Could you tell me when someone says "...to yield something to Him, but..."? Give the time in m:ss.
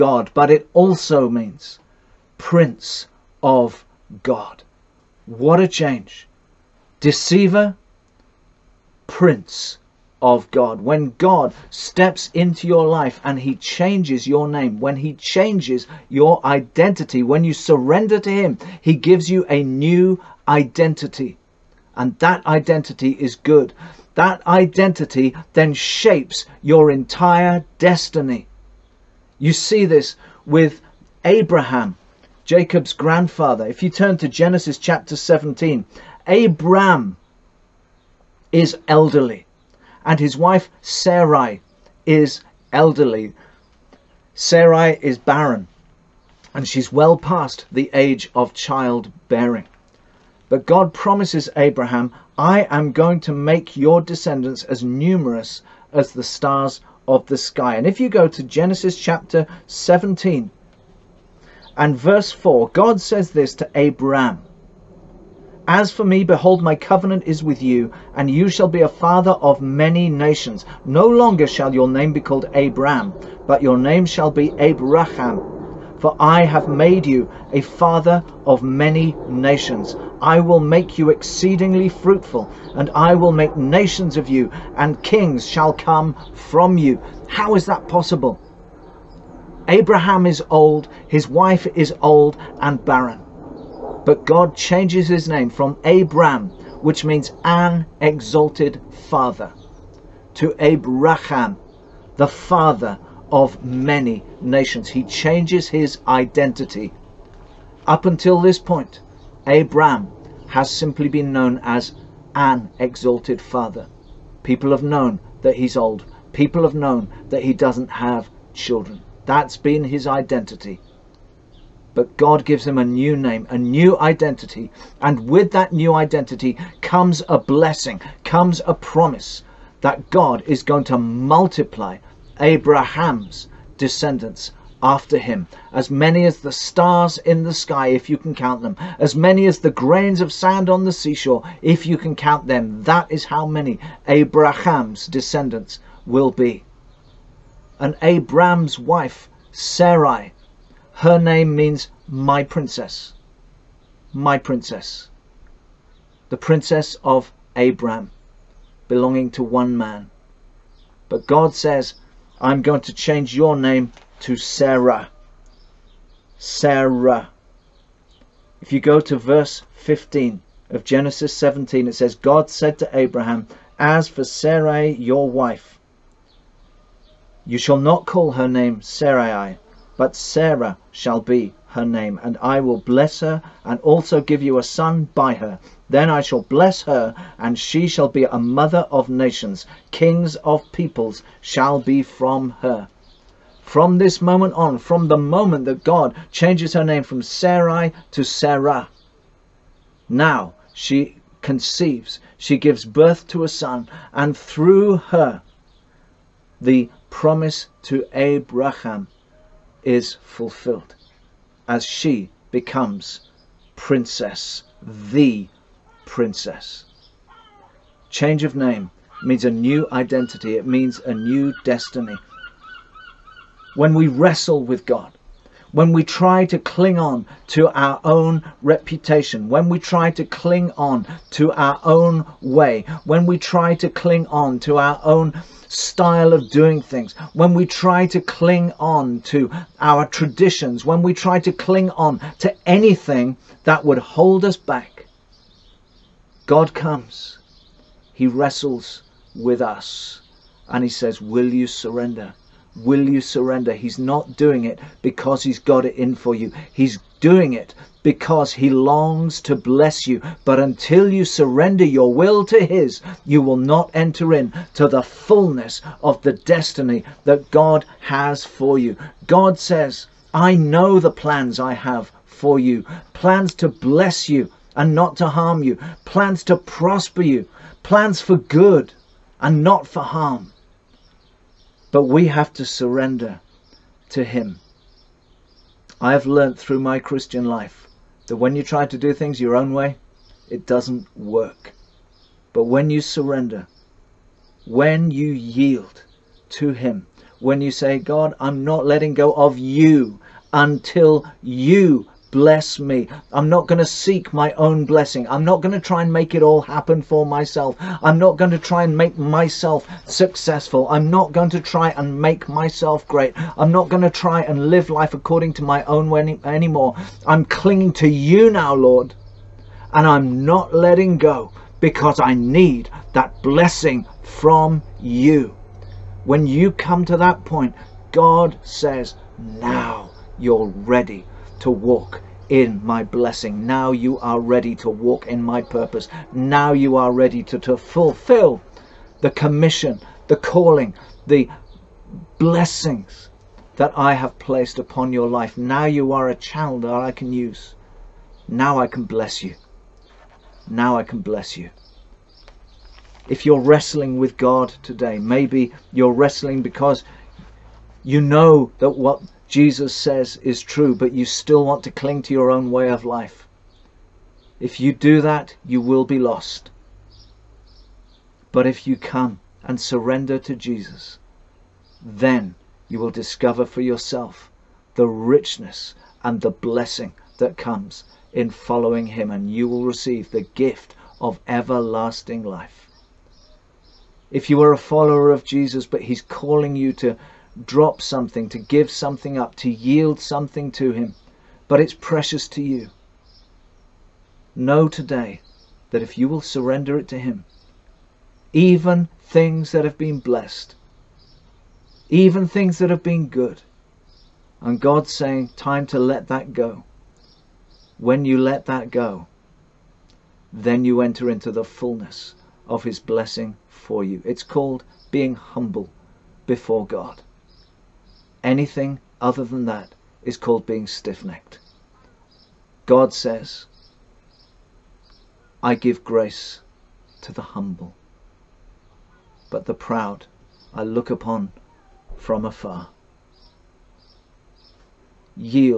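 6:29.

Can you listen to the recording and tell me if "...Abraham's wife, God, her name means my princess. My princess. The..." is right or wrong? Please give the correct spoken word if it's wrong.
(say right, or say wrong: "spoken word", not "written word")
wrong: "Sarai", not "God".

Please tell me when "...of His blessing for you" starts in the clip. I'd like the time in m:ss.
6:52.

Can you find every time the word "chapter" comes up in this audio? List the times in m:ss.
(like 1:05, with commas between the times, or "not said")
0:34, 0:58.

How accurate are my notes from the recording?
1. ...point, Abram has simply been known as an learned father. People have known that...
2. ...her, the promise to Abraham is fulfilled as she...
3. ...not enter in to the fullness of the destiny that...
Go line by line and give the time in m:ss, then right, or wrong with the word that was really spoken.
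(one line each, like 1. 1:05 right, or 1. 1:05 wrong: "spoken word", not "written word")
1. 1:48 wrong: "exalted", not "learned"
2. 3:24 right
3. 4:23 right.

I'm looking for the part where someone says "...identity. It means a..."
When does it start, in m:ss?
3:39.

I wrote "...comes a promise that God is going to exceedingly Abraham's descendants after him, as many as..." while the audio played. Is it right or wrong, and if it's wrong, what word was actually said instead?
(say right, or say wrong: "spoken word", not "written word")
wrong: "multiply", not "exceedingly".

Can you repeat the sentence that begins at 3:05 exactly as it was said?
Then I shall bless her, and she shall be a mother of nations.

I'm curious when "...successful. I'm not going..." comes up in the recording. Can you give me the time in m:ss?
5:10.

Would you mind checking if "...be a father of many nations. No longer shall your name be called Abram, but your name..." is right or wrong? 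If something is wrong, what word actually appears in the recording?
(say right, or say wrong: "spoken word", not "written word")
right.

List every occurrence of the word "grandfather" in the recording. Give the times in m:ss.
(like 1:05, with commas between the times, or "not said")
0:32.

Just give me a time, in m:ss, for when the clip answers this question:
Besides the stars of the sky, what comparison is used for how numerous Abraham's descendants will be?
2:19.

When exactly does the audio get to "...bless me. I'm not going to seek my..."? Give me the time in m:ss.
5:02.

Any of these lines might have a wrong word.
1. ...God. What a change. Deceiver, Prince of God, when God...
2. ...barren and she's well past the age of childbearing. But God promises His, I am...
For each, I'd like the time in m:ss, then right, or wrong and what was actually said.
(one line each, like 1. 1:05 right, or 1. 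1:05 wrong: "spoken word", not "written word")
1. 0:04 right
2. 0:45 wrong: "Abraham", not "His".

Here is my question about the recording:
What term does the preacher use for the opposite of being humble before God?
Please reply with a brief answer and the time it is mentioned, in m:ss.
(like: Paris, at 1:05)
stiff necked, at 7:00.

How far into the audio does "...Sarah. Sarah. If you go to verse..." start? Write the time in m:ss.
2:44.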